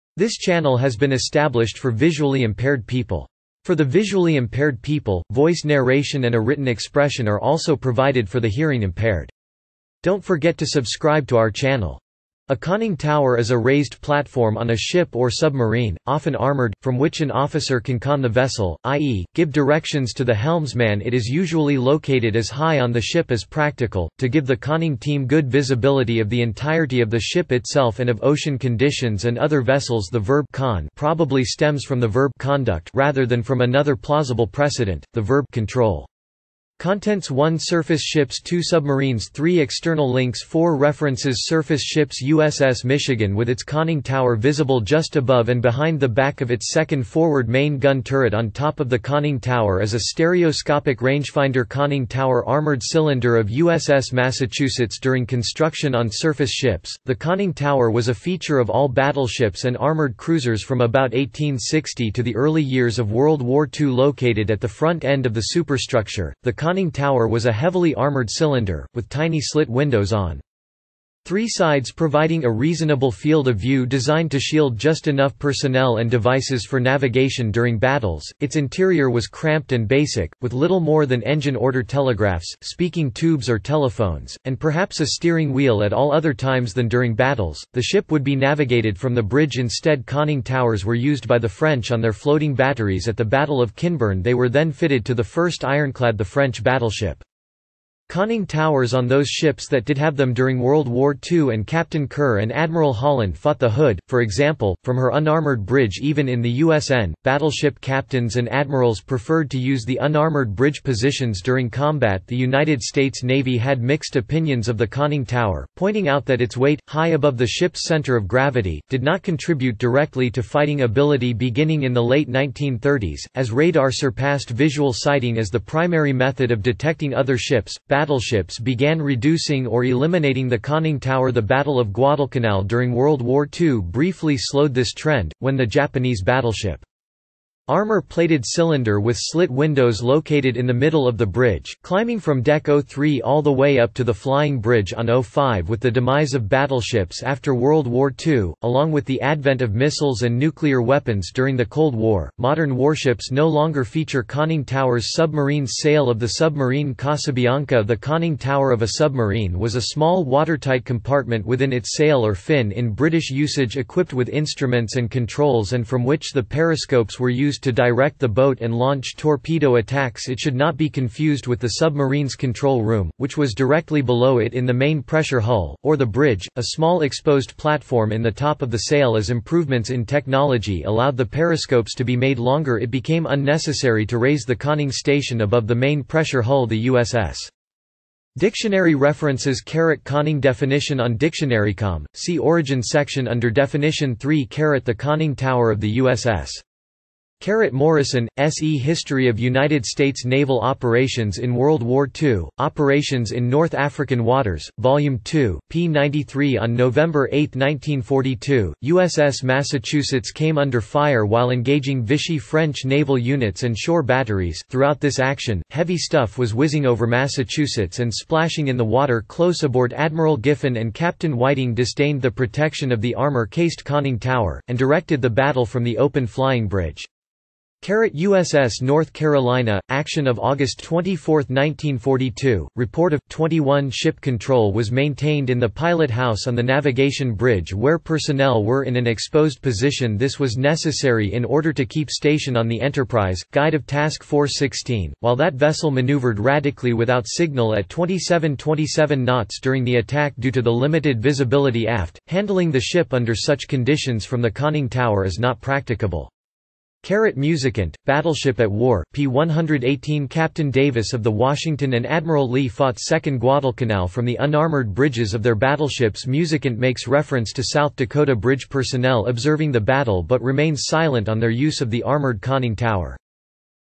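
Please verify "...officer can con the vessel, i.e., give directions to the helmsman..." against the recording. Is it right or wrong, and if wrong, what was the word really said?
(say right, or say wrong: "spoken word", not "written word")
right.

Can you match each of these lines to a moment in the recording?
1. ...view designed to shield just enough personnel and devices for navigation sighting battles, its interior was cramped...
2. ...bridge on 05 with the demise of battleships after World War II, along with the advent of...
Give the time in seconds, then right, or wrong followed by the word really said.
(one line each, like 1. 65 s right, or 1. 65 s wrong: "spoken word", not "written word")
1. 73 s wrong: "during", not "sighting"
2. 144 s right.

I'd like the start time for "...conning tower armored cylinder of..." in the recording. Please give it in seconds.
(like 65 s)
51 s.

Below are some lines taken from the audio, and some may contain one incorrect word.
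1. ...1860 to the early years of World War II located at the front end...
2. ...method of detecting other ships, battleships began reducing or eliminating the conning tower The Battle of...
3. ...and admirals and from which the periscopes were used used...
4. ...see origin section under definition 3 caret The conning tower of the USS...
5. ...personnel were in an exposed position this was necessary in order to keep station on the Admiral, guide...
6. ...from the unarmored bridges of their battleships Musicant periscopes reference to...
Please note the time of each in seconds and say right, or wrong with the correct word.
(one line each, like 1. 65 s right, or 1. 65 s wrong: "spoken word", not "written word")
1. 61 s right
2. 126 s right
3. 164 s wrong: "controls", not "admirals"
4. 192 s right
5. 237 s wrong: "Enterprise", not "Admiral"
6. 264 s wrong: "makes", not "periscopes".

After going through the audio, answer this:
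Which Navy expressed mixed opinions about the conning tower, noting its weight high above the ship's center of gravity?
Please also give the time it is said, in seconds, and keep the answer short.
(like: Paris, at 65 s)
United States Navy, at 112 s.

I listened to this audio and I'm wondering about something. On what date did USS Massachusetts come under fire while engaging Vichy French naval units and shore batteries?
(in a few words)
November 8, 1942.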